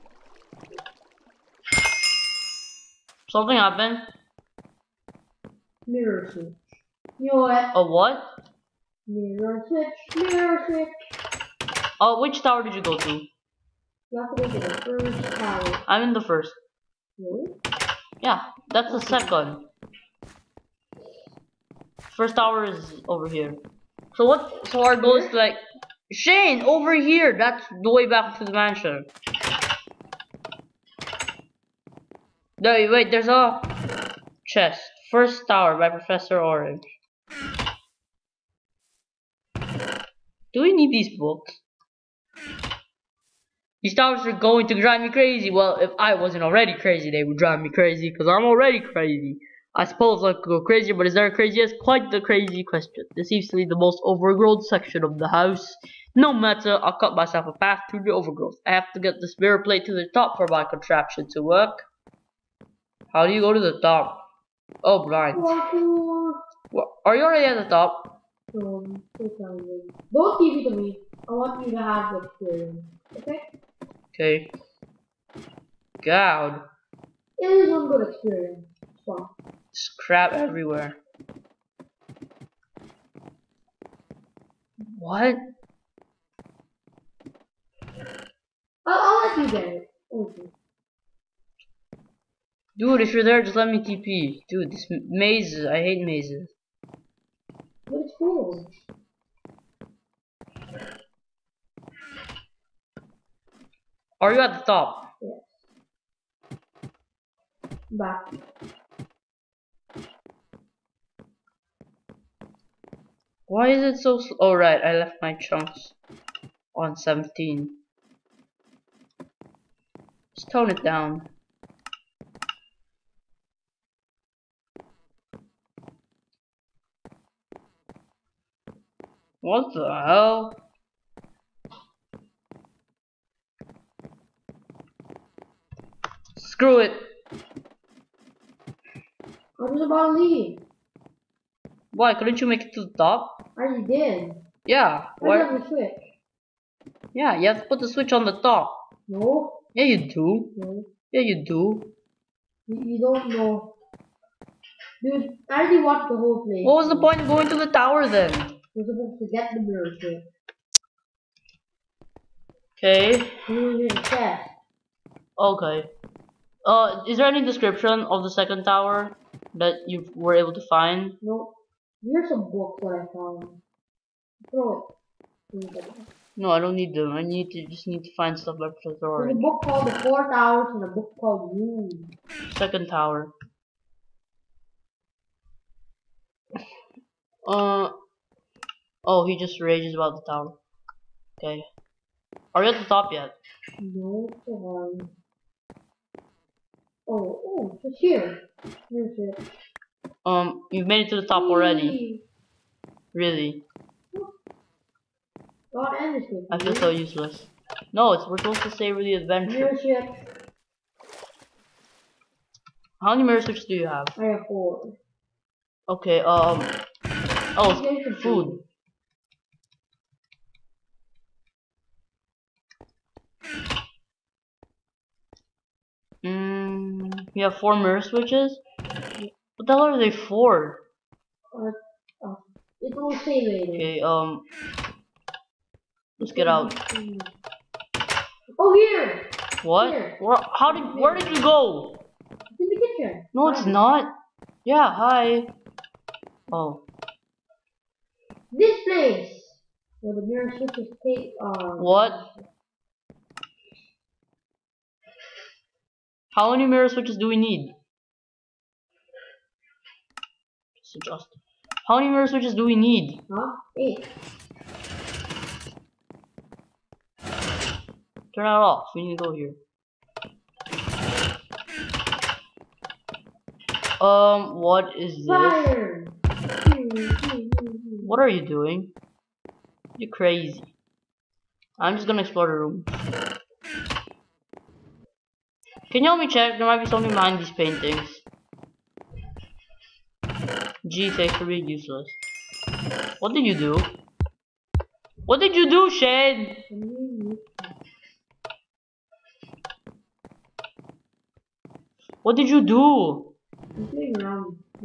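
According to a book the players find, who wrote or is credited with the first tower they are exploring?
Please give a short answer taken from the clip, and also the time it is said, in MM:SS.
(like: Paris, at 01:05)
Professor Orange, at 00:35.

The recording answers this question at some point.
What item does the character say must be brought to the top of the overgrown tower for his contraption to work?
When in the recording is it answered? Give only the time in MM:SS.
00:59.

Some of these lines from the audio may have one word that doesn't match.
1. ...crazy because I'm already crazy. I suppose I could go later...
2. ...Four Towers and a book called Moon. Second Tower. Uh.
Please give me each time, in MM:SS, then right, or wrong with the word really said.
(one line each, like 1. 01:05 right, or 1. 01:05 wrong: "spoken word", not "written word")
1. 00:47 wrong: "crazier", not "later"
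2. 02:59 right.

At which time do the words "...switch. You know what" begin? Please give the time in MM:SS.
00:06.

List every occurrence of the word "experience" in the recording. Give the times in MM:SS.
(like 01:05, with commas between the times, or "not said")
01:12, 01:18.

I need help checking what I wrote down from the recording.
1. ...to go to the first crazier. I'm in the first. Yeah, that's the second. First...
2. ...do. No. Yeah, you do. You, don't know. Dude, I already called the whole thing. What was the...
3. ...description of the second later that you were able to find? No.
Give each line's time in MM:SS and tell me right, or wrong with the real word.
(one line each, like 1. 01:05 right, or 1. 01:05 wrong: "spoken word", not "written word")
1. 00:14 wrong: "tower", not "crazier"
2. 02:30 wrong: "watched", not "called"
3. 02:47 wrong: "tower", not "later".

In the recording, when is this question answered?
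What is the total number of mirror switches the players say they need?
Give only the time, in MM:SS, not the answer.
04:23.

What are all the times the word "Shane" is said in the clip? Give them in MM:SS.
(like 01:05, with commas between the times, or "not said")
00:26, 04:55.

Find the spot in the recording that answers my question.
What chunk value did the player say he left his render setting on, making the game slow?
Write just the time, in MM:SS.
01:56.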